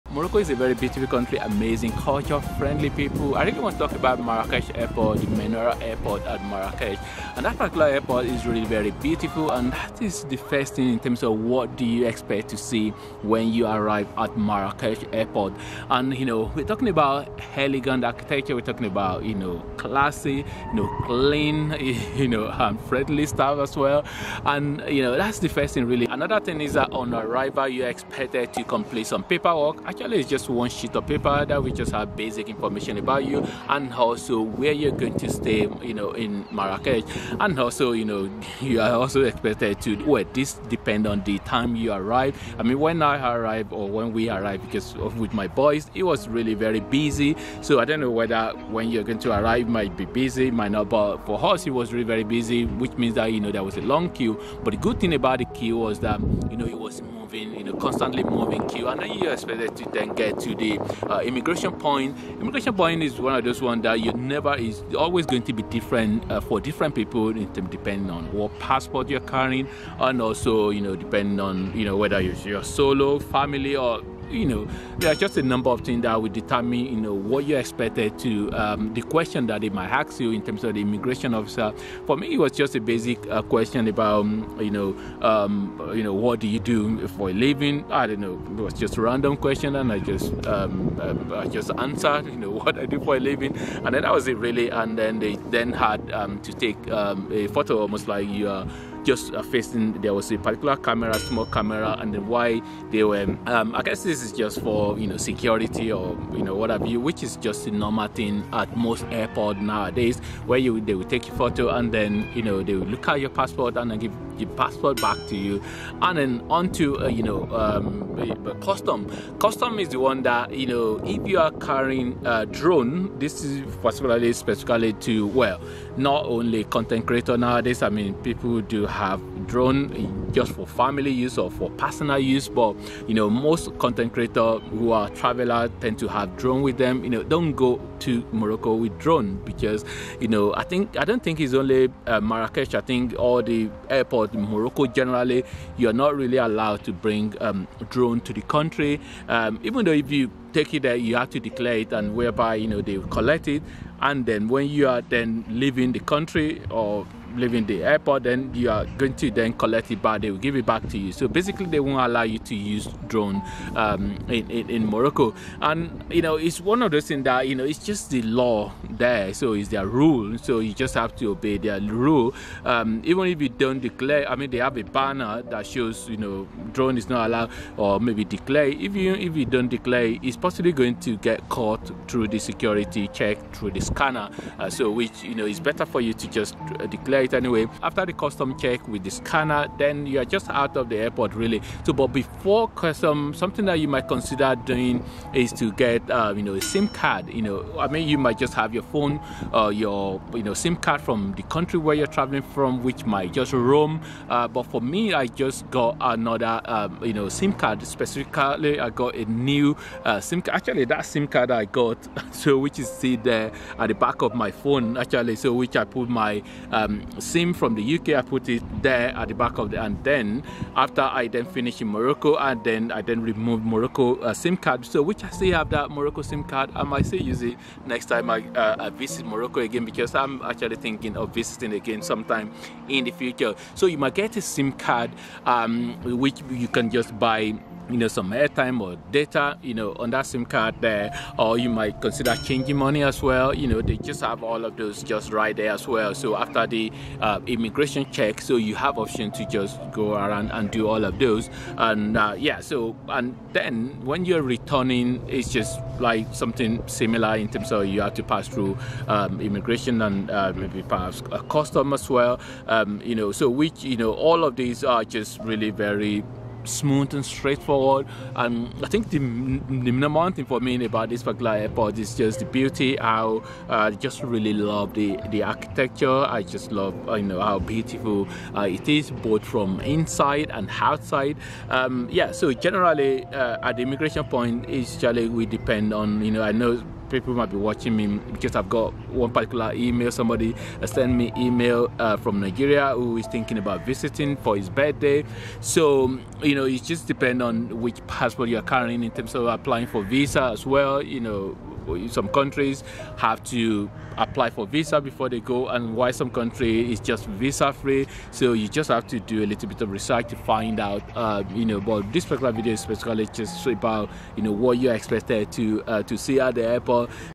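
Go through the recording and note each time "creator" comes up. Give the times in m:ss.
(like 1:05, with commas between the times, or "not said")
2:07, 2:14.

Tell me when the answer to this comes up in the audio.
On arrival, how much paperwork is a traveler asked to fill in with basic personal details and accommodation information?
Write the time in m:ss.
0:30.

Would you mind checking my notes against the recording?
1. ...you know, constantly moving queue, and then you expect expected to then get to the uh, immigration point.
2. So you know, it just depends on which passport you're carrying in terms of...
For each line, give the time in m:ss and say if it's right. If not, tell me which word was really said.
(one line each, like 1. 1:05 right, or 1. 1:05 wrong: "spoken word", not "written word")
1. 0:57 right
2. 4:55 right.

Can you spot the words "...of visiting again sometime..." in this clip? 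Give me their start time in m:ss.
3:51.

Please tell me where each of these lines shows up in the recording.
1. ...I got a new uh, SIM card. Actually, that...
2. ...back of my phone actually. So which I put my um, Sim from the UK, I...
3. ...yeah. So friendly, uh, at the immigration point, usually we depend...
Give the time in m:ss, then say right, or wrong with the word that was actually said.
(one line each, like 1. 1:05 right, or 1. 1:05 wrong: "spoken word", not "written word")
1. 3:28 right
2. 3:33 right
3. 4:42 wrong: "generally", not "friendly".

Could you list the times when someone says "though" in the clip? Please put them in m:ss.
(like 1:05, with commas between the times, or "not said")
2:29.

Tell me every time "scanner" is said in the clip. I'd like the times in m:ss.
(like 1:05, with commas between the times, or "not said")
3:03, 3:09.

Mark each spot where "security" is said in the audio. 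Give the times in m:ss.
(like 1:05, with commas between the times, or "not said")
1:45, 3:02.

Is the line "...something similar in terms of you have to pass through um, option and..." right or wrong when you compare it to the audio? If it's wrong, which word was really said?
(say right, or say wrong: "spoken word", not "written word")
wrong: "immigration", not "option".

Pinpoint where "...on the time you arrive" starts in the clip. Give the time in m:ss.
0:41.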